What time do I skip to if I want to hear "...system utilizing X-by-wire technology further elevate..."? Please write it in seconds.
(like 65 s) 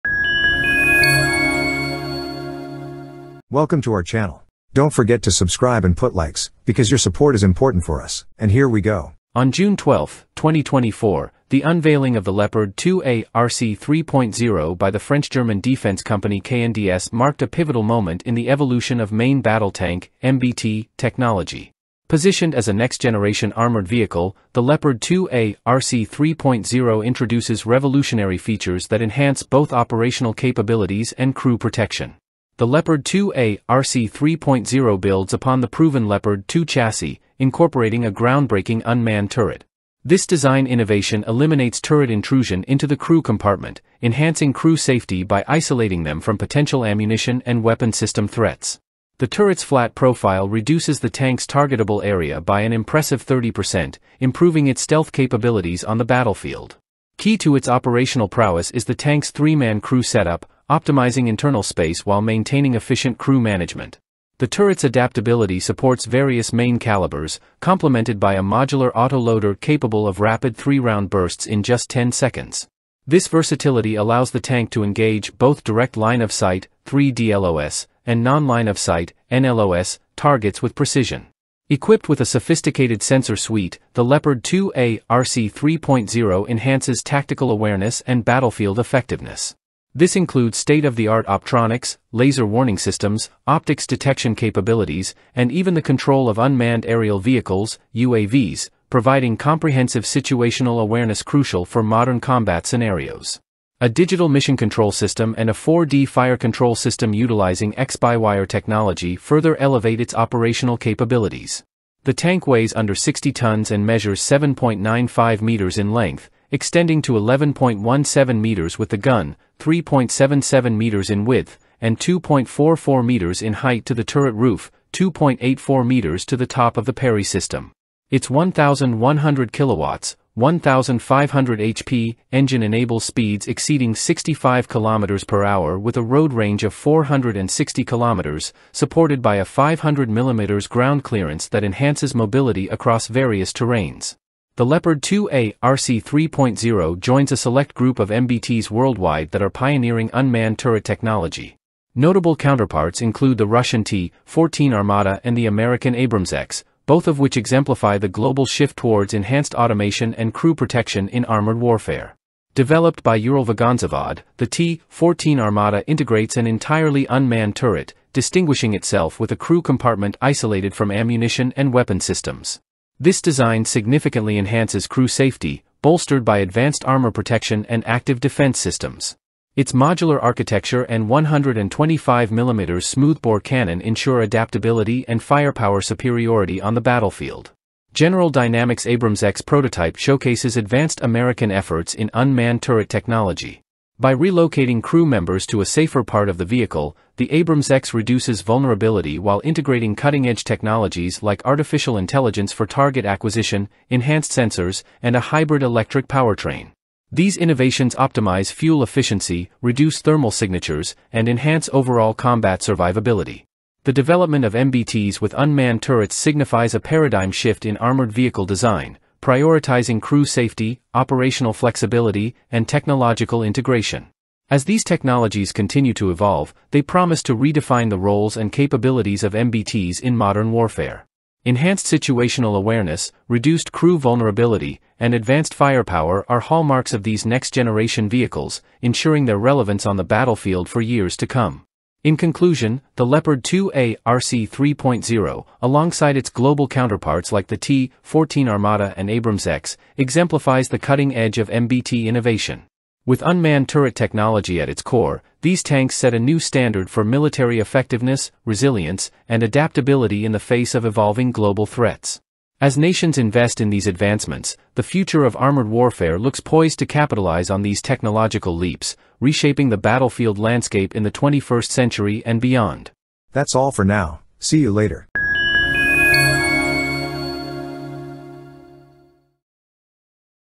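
106 s.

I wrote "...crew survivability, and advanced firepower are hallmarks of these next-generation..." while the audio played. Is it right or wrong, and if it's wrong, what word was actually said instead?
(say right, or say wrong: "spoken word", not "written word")
wrong: "vulnerability", not "survivability".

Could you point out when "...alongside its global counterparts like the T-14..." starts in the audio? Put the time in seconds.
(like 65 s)
245 s.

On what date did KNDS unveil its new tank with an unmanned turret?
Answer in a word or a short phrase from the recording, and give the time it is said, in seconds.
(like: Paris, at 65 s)
June 12, 2024, at 9 s.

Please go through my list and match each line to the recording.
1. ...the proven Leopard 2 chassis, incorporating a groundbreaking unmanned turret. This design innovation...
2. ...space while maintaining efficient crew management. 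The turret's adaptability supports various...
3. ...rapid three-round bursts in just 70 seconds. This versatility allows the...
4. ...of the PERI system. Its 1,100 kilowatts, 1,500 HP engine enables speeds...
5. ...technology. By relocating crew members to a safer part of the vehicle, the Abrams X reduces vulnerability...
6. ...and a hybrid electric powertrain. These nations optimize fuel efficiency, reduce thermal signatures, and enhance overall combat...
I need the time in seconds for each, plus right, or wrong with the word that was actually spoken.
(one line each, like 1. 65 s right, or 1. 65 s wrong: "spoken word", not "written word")
1. 35 s right
2. 61 s right
3. 70 s wrong: "10", not "70"
4. 126 s right
5. 192 s right
6. 205 s wrong: "innovations", not "nations".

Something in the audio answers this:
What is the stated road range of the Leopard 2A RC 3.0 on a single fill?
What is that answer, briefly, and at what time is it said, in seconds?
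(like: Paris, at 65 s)
460 km, at 136 s.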